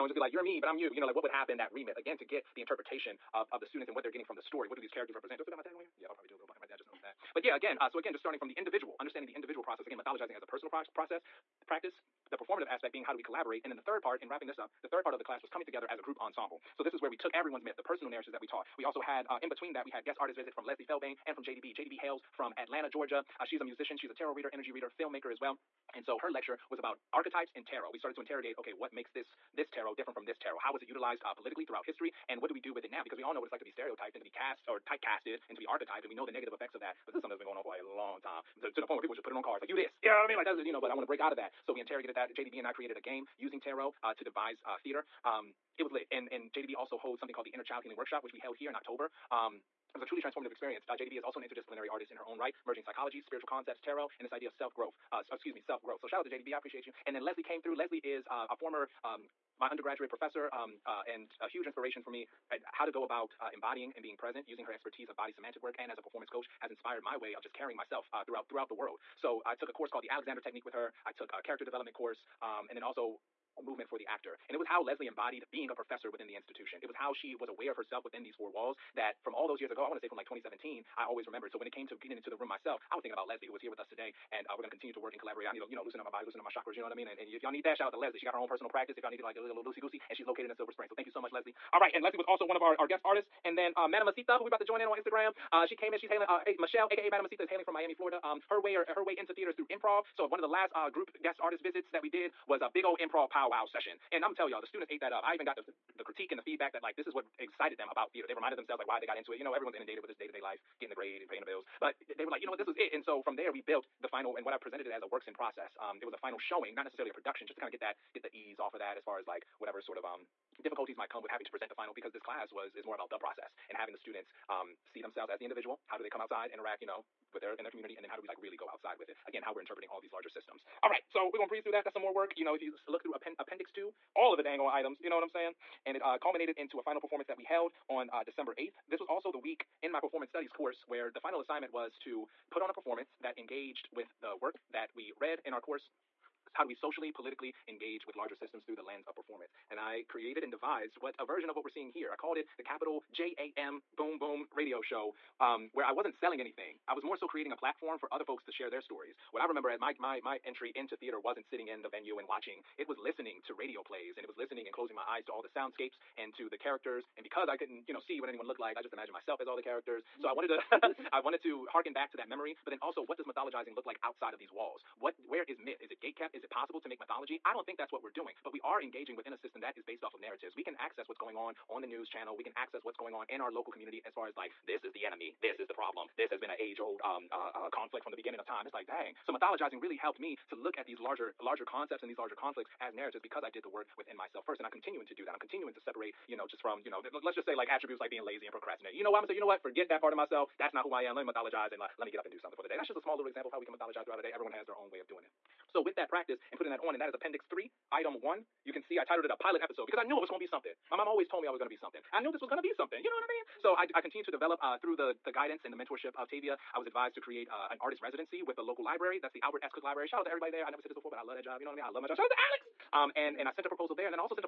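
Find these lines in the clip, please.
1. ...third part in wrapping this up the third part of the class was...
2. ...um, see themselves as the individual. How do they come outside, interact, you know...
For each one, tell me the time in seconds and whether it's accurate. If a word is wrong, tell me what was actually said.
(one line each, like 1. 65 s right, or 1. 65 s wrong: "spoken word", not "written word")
1. 13 s right
2. 124 s right.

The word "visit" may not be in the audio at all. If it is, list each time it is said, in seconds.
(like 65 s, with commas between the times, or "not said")
20 s, 101 s.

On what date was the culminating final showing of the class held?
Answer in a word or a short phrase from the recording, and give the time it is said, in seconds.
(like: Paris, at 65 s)
December 8th, at 138 s.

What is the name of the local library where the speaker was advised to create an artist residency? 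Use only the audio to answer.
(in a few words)
Albert S. Cook Library.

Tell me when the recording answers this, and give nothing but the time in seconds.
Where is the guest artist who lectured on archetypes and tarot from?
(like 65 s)
22 s.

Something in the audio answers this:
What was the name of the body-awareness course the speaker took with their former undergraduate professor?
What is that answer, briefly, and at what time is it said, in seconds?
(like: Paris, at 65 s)
The Alexander Technique, at 70 s.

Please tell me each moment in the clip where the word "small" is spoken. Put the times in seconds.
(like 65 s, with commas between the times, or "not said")
202 s.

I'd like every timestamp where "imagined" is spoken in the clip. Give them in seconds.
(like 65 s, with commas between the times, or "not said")
168 s.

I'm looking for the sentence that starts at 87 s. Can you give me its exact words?
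And, and if y'all need that, shout out to Leslie.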